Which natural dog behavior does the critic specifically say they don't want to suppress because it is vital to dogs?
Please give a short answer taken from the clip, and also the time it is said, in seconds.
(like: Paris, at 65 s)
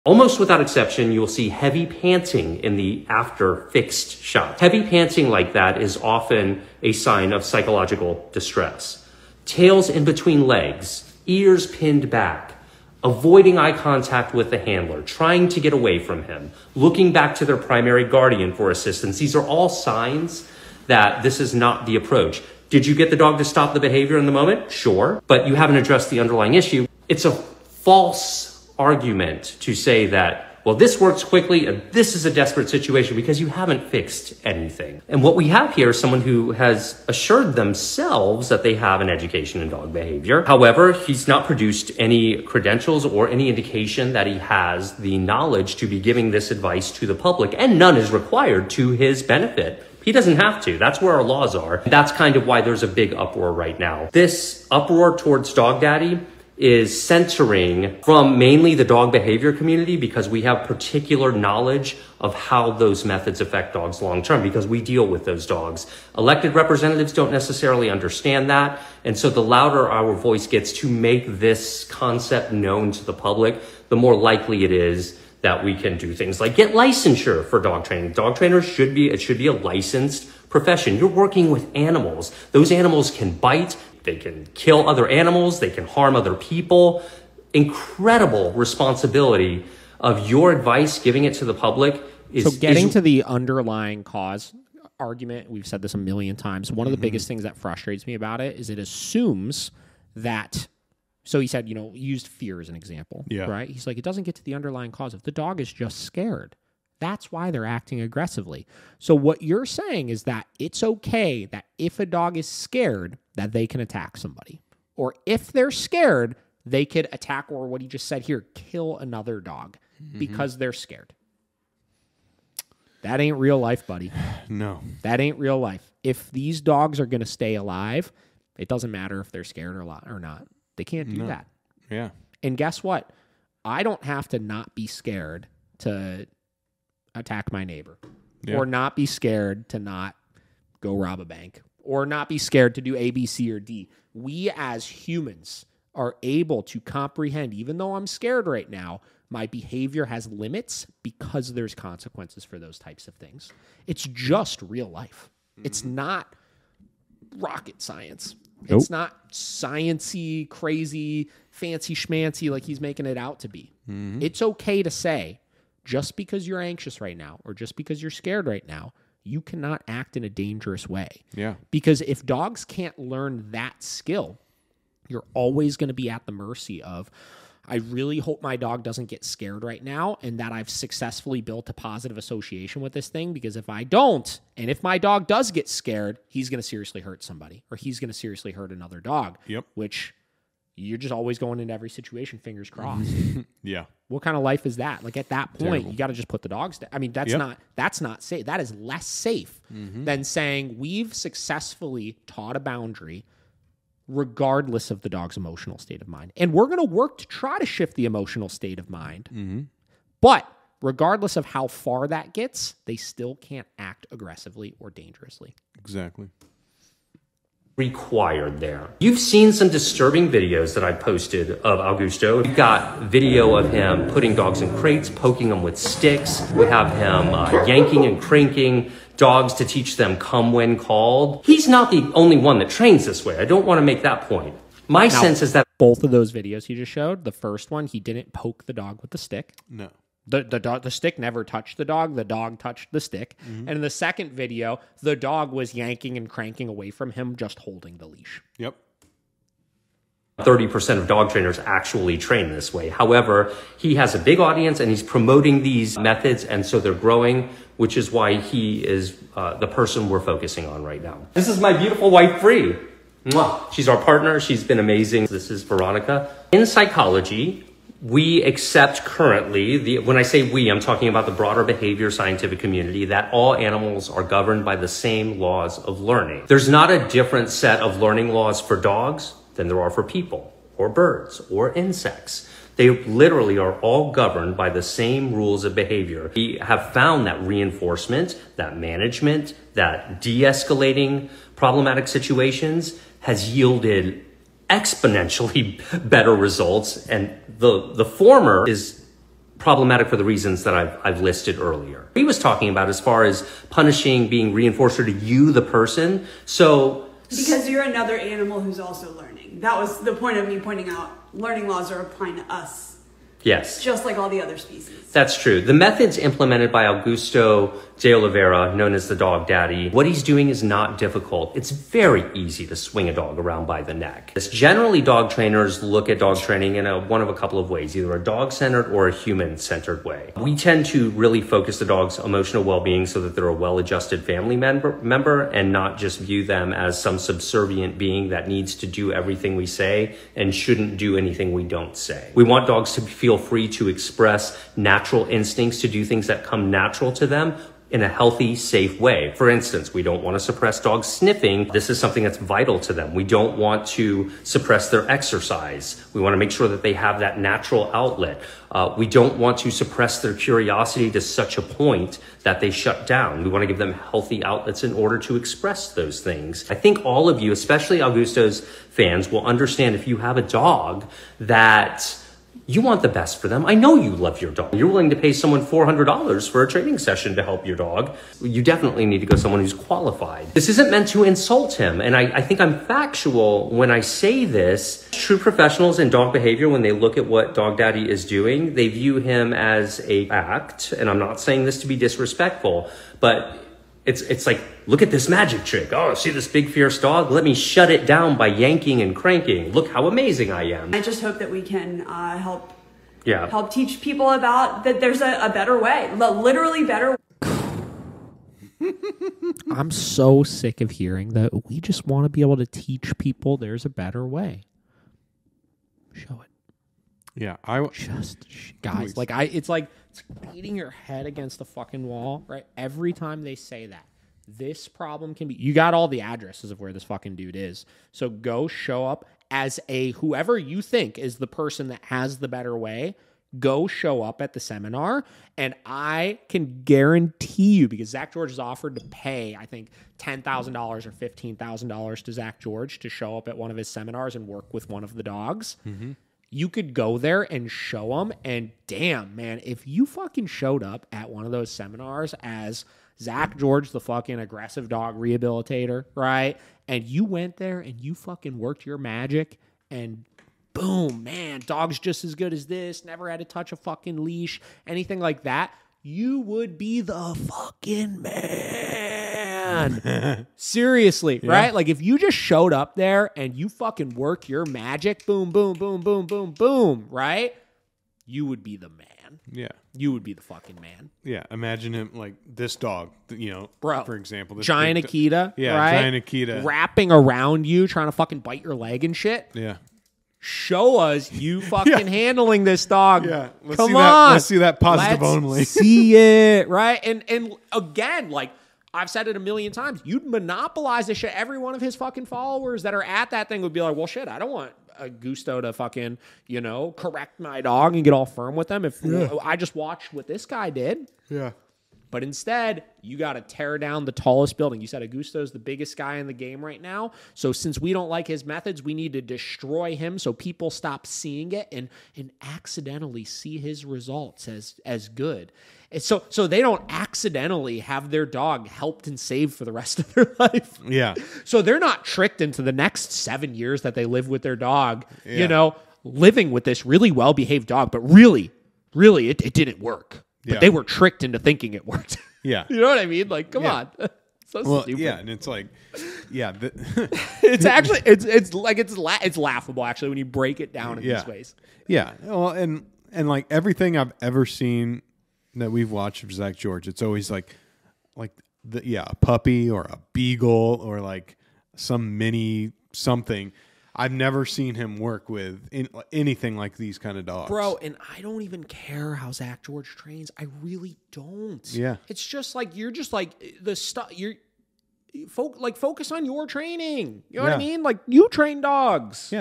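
Sniffing, at 351 s.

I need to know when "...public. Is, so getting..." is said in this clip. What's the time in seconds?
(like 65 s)
91 s.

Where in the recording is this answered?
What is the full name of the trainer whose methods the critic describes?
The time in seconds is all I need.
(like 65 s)
316 s.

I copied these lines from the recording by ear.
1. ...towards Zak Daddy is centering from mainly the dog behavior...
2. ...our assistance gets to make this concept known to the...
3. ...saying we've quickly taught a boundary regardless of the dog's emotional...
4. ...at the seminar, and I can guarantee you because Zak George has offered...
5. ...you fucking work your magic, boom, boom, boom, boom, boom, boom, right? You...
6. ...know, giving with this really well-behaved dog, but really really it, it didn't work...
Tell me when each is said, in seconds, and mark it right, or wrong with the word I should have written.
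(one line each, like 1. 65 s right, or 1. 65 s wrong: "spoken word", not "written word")
1. 55 s wrong: "Dog", not "Zak"
2. 69 s wrong: "voice", not "assistance"
3. 200 s wrong: "successfully", not "quickly"
4. 434 s right
5. 473 s right
6. 535 s wrong: "living", not "giving".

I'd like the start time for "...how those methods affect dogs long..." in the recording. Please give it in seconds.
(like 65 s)
62 s.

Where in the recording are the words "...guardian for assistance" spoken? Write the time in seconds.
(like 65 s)
18 s.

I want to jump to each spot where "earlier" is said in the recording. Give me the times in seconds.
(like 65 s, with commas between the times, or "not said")
301 s.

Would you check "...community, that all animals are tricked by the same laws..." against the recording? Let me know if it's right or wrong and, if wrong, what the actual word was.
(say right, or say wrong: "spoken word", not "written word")
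wrong: "governed", not "tricked".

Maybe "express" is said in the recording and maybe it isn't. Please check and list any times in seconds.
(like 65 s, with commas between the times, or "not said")
343 s, 365 s.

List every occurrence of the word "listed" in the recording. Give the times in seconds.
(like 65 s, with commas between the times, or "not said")
301 s.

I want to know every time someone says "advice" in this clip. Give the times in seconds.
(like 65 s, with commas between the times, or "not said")
46 s, 90 s.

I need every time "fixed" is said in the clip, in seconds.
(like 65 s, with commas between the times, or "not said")
3 s, 33 s.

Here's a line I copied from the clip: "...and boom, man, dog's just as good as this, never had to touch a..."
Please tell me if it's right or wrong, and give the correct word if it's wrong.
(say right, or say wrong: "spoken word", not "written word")
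right.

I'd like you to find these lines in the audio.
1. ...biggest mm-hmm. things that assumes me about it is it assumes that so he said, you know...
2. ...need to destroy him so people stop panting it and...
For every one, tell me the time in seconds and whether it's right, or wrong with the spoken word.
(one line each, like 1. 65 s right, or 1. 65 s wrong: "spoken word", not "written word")
1. 96 s wrong: "frustrates", not "assumes"
2. 518 s wrong: "seeing", not "panting".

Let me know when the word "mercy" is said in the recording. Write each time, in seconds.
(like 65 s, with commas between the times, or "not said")
176 s.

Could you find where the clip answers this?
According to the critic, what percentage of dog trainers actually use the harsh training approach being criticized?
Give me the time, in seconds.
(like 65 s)
250 s.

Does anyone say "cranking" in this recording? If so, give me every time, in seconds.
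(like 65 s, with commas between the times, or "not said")
228 s, 246 s, 399 s.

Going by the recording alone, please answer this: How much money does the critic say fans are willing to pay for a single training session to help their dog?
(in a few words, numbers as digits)
$400.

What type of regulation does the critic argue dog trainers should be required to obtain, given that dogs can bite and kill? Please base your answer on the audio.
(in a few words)
Licensure.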